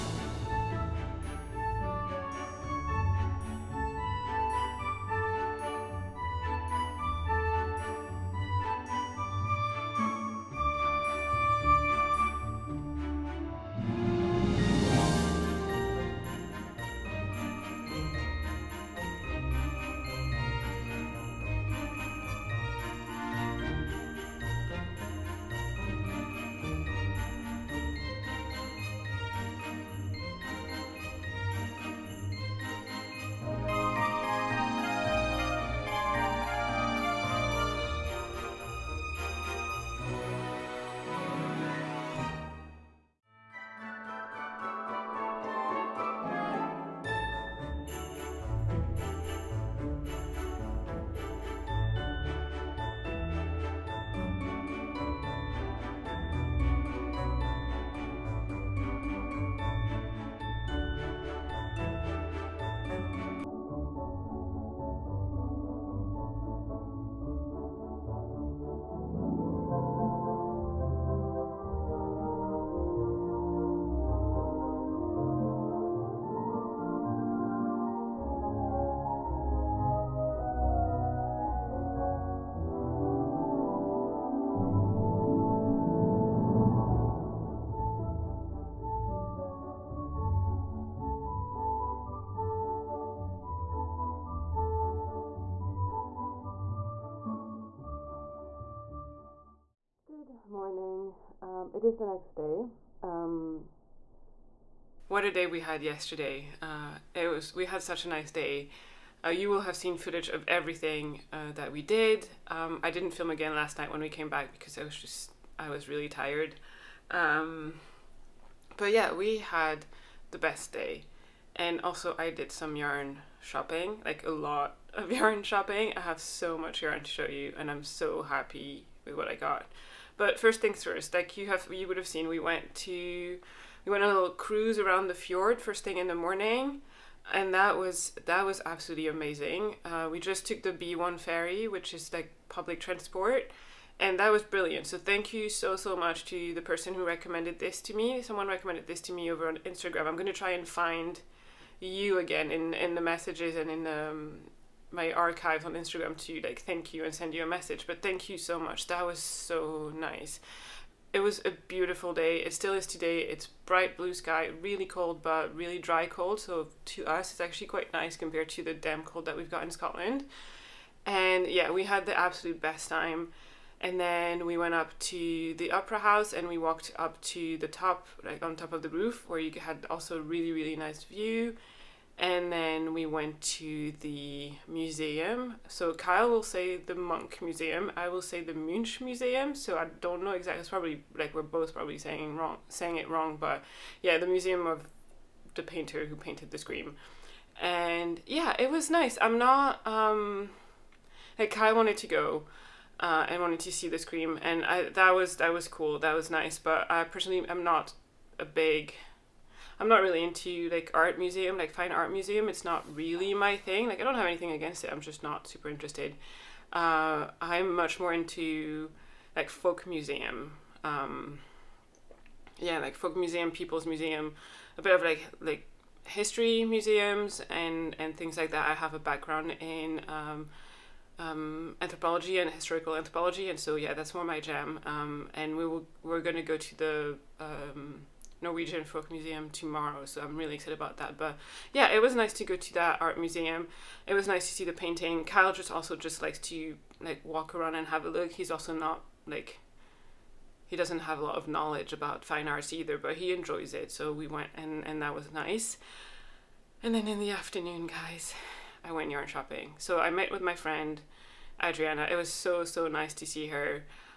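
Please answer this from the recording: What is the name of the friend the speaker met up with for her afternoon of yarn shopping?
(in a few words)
Adriana.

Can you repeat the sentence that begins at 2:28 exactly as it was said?
Someone recommended this to me over on Instagram.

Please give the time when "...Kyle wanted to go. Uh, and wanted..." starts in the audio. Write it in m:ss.
3:21.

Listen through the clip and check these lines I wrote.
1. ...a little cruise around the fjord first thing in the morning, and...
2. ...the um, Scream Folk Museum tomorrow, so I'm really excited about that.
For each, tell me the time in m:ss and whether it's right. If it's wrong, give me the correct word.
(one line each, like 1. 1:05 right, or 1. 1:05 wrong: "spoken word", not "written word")
1. 2:14 right
2. 3:56 wrong: "Norwegian", not "Scream".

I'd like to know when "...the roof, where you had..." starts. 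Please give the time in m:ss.
2:58.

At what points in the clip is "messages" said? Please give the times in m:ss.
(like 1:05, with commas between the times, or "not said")
2:32, 2:37.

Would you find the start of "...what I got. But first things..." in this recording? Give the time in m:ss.
2:09.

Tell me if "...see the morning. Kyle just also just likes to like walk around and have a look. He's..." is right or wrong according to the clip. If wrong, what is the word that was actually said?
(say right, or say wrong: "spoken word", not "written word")
wrong: "painting", not "morning".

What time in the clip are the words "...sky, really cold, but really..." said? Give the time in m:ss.
2:44.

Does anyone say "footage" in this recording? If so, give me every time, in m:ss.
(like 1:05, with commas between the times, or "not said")
1:49.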